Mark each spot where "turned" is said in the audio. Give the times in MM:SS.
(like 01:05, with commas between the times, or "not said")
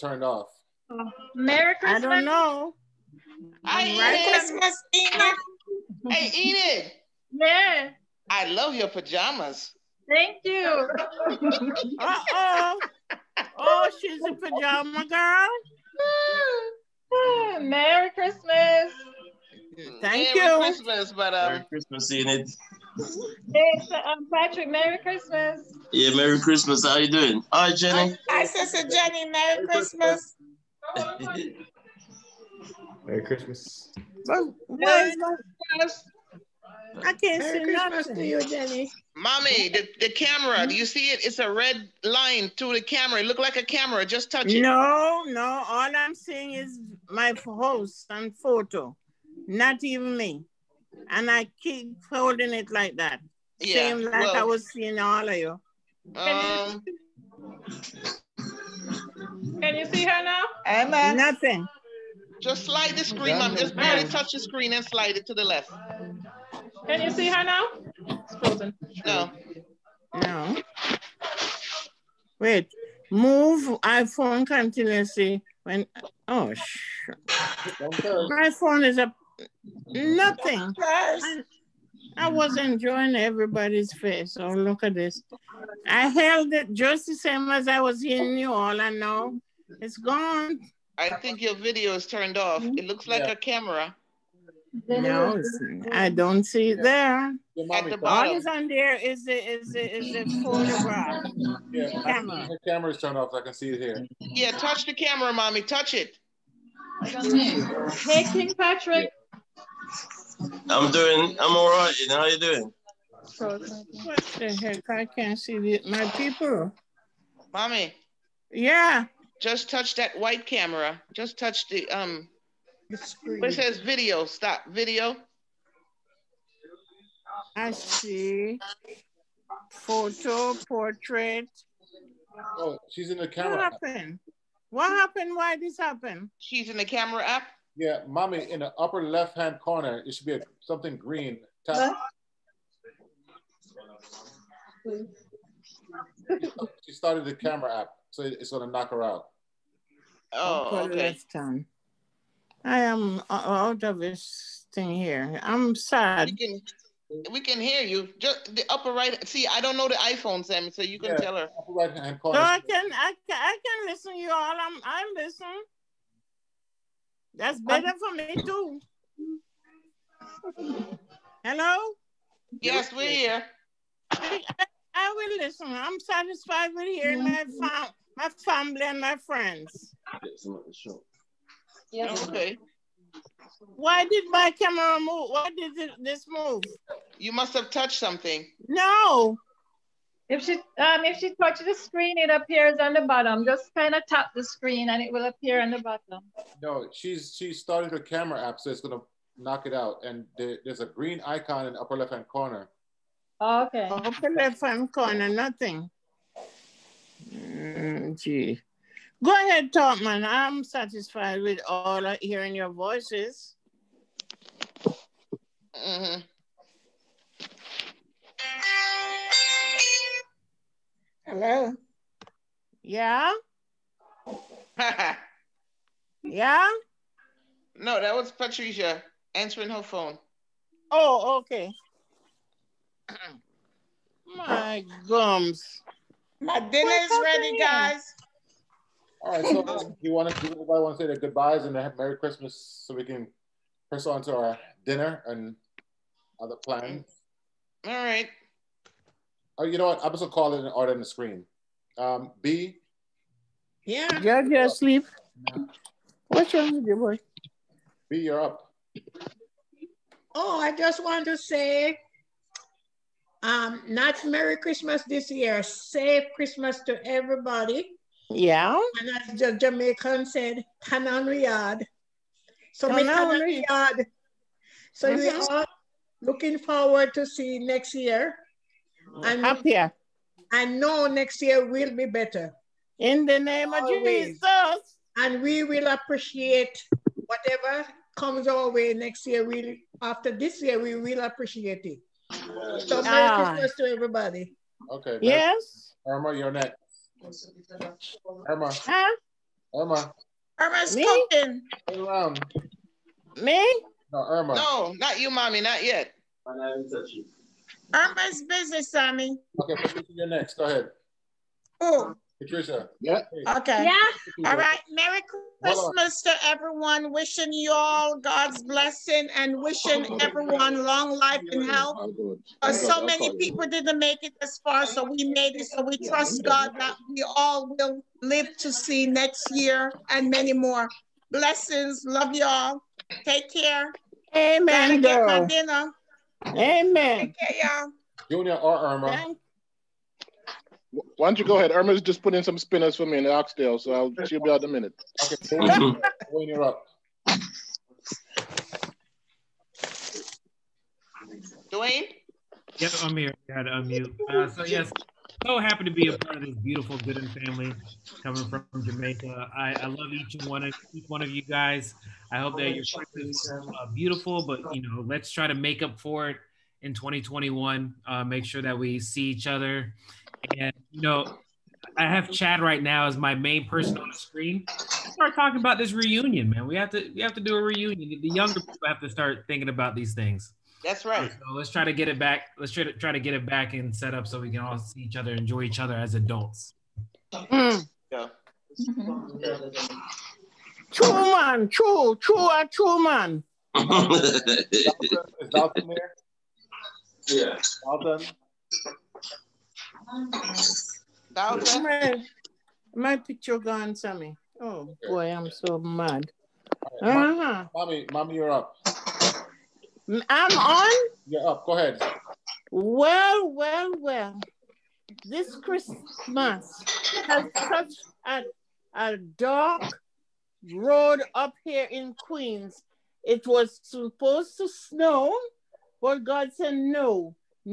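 01:32, 01:42.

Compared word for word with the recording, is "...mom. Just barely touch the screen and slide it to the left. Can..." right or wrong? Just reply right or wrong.
right.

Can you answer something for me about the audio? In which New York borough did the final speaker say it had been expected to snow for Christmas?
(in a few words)
Queens.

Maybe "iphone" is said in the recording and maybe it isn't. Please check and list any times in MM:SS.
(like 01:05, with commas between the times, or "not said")
01:13, 02:39.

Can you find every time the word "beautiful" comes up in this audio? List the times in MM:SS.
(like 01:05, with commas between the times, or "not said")
05:56, 06:03.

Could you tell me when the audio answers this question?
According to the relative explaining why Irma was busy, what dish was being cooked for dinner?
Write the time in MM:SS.
05:43.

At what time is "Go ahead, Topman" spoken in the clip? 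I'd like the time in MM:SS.
03:29.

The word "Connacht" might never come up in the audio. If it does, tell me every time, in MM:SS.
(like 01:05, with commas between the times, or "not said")
not said.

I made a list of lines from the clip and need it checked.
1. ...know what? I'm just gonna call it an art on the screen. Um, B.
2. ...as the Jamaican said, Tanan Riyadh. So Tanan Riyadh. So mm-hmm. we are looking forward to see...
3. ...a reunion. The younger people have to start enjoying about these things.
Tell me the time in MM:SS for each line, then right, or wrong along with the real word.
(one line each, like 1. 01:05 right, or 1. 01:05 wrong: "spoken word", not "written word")
1. 04:09 right
2. 04:29 right
3. 06:17 wrong: "thinking", not "enjoying".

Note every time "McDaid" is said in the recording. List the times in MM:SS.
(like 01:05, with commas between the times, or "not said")
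not said.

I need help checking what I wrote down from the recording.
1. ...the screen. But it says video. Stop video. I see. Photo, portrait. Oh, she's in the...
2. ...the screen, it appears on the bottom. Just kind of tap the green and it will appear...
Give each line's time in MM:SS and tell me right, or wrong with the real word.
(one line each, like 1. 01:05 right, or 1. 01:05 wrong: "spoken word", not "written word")
1. 02:02 right
2. 03:11 wrong: "screen", not "green".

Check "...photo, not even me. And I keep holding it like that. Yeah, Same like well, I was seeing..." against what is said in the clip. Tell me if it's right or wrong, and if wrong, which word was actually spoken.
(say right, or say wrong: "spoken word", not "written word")
right.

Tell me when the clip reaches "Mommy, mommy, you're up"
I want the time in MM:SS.
06:47.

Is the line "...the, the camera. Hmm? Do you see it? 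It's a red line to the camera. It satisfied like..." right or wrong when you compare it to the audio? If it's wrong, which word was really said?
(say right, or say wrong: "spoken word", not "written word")
wrong: "looked", not "satisfied".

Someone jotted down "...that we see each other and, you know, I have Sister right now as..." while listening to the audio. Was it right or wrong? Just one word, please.
wrong.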